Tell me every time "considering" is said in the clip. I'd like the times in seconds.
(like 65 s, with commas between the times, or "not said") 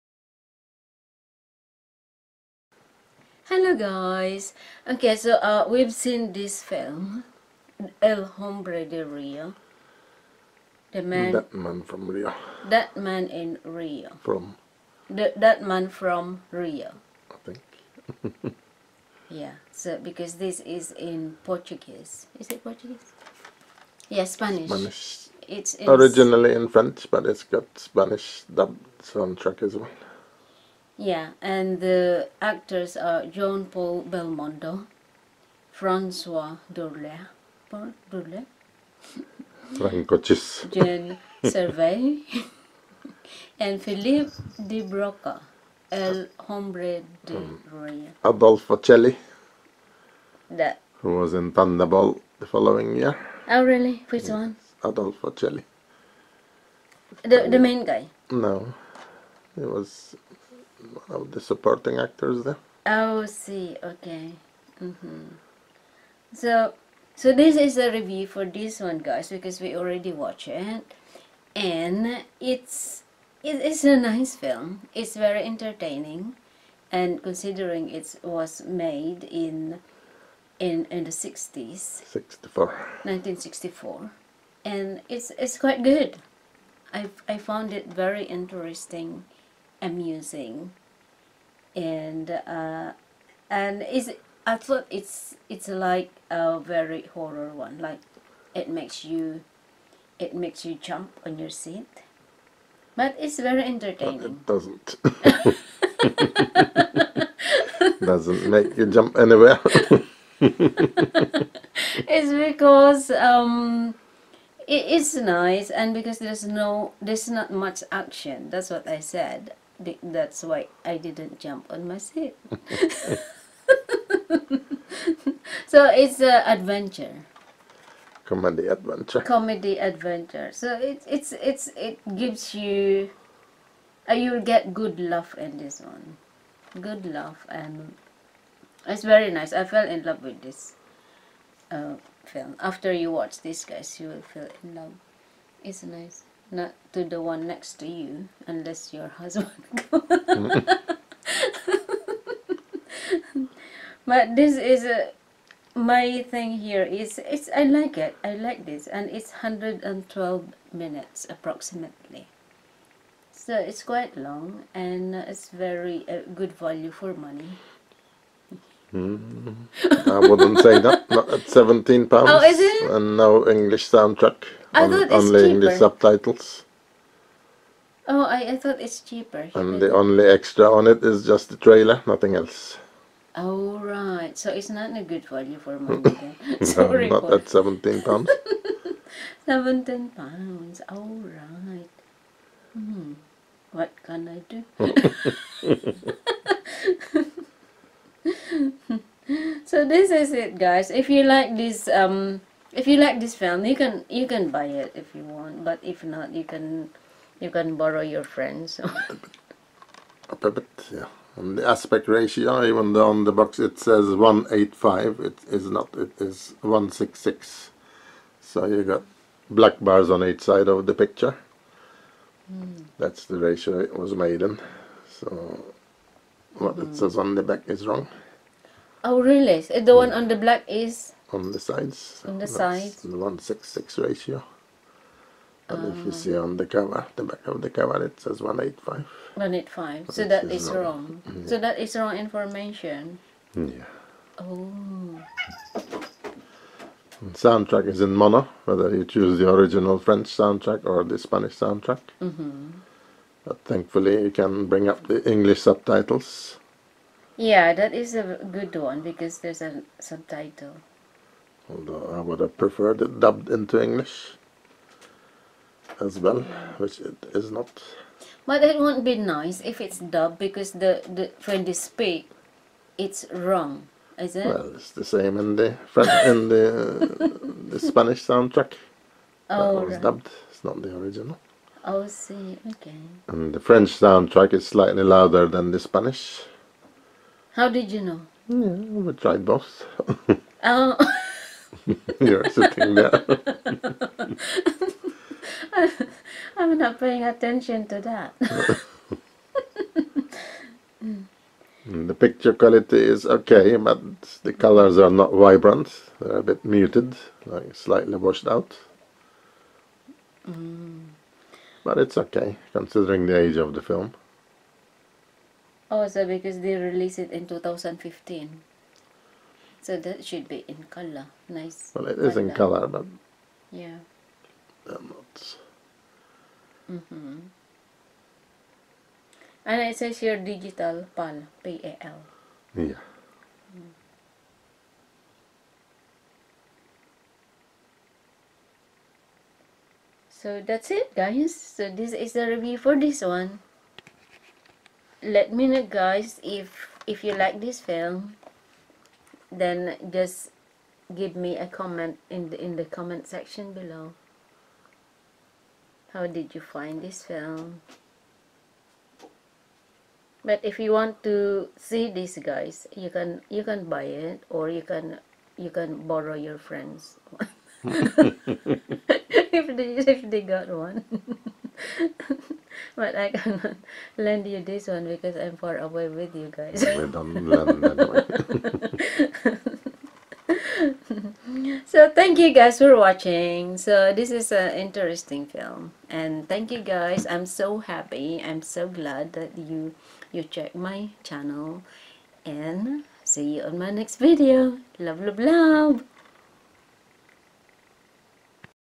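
77 s, 312 s.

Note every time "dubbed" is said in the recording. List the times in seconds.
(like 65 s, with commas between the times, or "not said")
28 s, 263 s, 269 s, 280 s.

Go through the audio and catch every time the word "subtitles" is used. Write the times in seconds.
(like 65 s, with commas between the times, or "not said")
175 s, 255 s, 259 s.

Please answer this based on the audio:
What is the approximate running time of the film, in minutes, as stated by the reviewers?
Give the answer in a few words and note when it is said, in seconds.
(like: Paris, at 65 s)
112 minutes, at 159 s.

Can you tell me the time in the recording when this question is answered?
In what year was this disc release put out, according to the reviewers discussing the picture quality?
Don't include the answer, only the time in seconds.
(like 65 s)
317 s.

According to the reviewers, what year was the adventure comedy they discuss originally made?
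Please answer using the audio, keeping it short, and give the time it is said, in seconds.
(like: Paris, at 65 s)
1964, at 83 s.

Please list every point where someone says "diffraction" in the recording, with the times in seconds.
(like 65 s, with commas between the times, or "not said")
not said.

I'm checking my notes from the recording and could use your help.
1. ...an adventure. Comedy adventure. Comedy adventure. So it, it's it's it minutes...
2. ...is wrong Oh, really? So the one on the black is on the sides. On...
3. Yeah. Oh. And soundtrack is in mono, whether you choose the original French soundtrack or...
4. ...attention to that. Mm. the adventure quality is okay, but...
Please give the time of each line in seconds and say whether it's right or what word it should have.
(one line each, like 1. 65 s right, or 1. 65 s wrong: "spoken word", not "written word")
1. 126 s wrong: "gives", not "minutes"
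2. 227 s right
3. 243 s right
4. 297 s wrong: "picture", not "adventure".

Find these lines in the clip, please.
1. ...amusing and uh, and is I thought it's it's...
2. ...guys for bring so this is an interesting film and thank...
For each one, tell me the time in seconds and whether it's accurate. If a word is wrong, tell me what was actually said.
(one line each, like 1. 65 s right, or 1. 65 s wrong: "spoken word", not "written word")
1. 89 s right
2. 382 s wrong: "watching", not "bring".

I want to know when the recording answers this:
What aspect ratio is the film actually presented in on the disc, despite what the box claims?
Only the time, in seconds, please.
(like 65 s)
216 s.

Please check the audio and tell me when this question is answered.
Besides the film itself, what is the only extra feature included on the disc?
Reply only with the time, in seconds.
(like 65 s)
181 s.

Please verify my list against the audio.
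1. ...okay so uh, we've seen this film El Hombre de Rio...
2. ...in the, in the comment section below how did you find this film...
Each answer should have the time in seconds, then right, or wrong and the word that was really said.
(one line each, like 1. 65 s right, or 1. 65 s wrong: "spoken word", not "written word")
1. 4 s right
2. 352 s right.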